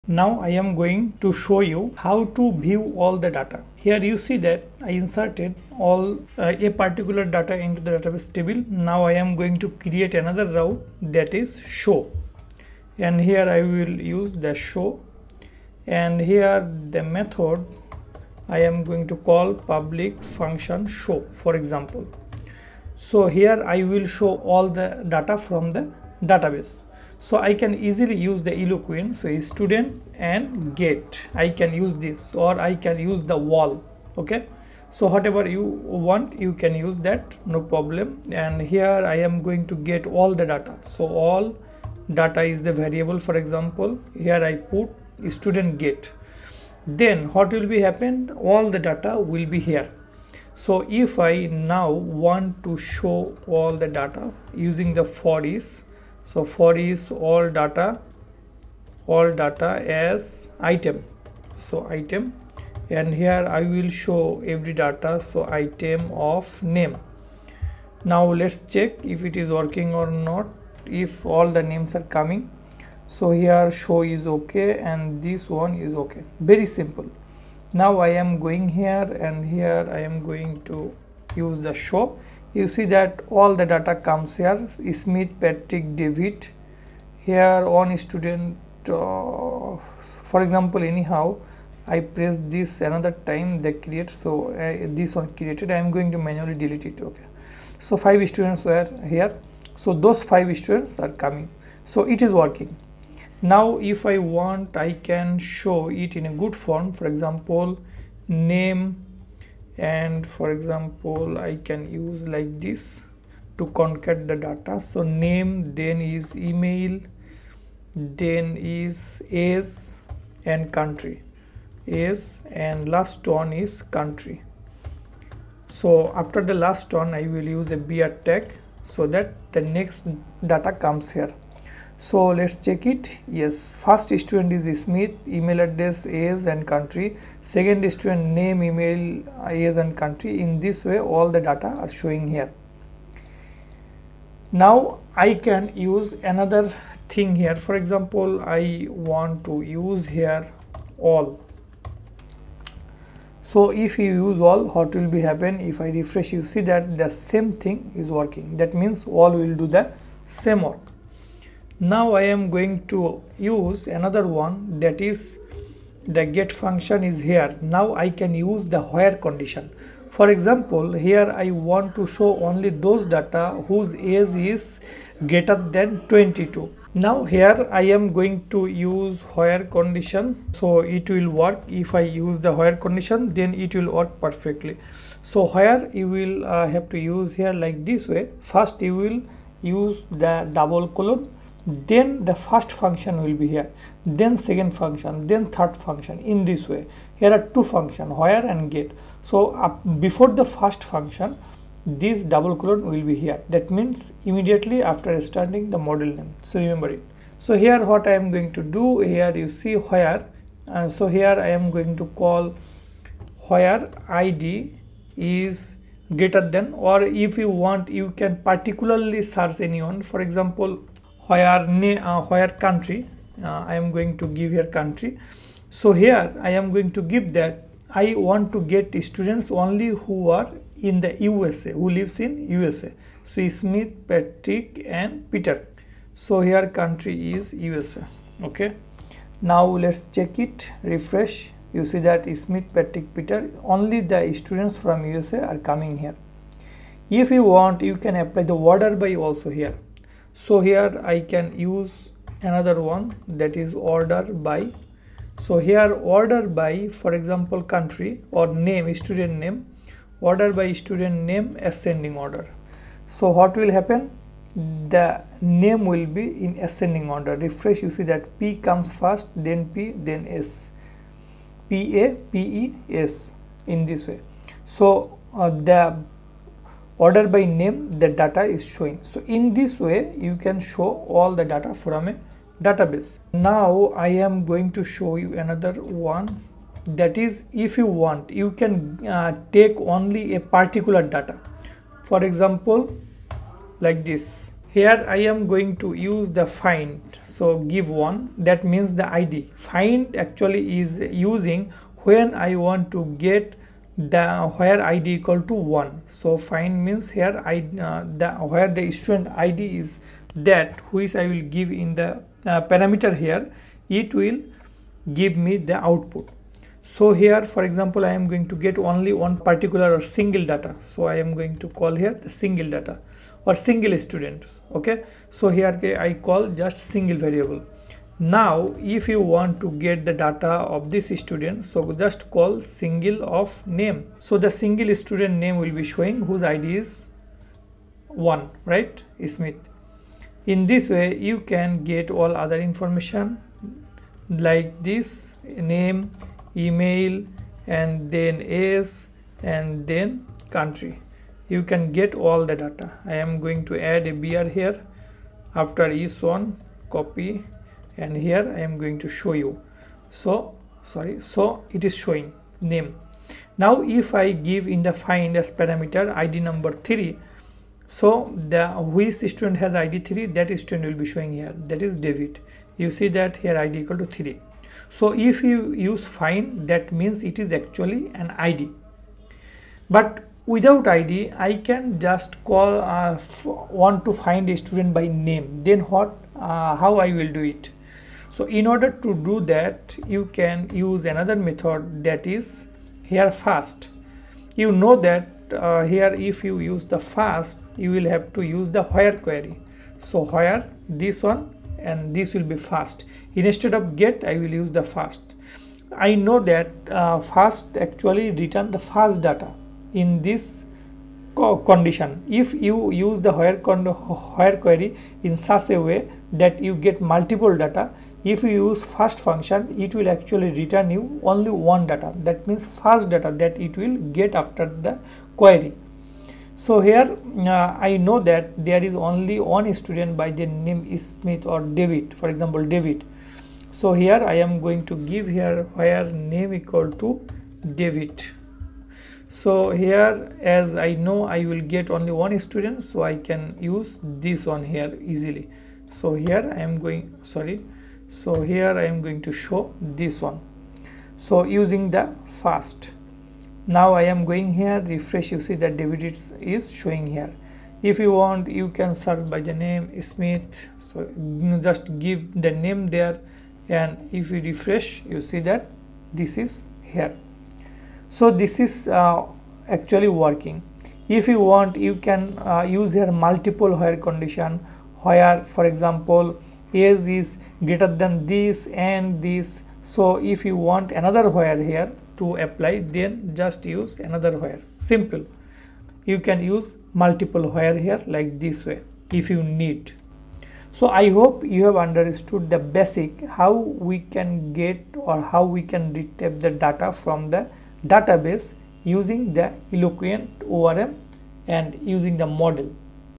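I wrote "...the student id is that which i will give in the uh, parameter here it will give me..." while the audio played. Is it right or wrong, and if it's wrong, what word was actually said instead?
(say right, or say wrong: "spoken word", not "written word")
right.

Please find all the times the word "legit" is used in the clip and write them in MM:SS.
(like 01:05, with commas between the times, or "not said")
not said.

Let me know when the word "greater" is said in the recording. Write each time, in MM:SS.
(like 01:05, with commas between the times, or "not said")
02:55, 03:36, 07:57.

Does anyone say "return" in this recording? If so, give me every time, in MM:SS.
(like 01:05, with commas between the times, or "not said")
06:48, 07:00.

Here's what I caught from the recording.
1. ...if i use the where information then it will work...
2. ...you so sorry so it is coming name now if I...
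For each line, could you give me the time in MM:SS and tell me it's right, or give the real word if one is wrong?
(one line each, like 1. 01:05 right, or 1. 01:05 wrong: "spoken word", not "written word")
1. 03:01 wrong: "condition", not "information"
2. 05:59 wrong: "showing", not "coming".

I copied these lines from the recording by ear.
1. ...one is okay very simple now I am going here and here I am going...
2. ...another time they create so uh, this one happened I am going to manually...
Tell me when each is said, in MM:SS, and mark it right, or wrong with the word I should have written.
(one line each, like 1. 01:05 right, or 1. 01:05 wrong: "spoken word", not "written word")
1. 01:15 right
2. 01:32 wrong: "created", not "happened".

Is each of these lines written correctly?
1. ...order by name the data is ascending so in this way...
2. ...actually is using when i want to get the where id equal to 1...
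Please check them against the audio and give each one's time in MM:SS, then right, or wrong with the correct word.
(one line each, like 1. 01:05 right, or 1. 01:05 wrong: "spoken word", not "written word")
1. 04:37 wrong: "showing", not "ascending"
2. 05:00 right.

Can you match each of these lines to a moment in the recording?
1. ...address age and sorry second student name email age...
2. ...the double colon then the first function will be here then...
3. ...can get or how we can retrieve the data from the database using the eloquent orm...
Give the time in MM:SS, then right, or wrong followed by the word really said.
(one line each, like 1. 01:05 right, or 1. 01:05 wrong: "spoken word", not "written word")
1. 02:15 wrong: "country", not "sorry"
2. 03:10 right
3. 08:13 right.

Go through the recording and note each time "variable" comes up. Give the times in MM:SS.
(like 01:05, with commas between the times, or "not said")
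00:42, 05:27.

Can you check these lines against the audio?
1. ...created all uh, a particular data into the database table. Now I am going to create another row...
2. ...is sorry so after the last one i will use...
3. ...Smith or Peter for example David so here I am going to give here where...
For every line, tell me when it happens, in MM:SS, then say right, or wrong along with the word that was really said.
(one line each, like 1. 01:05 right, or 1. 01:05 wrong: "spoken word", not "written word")
1. 00:04 wrong: "inserted", not "created"
2. 02:03 wrong: "country", not "sorry"
3. 07:11 wrong: "David", not "Peter".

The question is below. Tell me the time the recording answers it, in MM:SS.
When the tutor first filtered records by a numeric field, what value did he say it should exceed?
02:56.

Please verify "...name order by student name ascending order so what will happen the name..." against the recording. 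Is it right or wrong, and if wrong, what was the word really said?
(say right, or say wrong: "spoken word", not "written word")
right.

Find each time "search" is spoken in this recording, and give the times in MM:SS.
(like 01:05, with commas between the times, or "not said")
03:39, 07:38.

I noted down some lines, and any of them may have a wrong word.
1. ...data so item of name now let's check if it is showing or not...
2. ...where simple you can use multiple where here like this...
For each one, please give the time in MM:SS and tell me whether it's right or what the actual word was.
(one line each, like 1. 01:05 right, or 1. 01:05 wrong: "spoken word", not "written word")
1. 01:04 wrong: "working", not "showing"
2. 08:04 right.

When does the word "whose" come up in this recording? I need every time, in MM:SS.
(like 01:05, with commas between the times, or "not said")
02:53, 05:36.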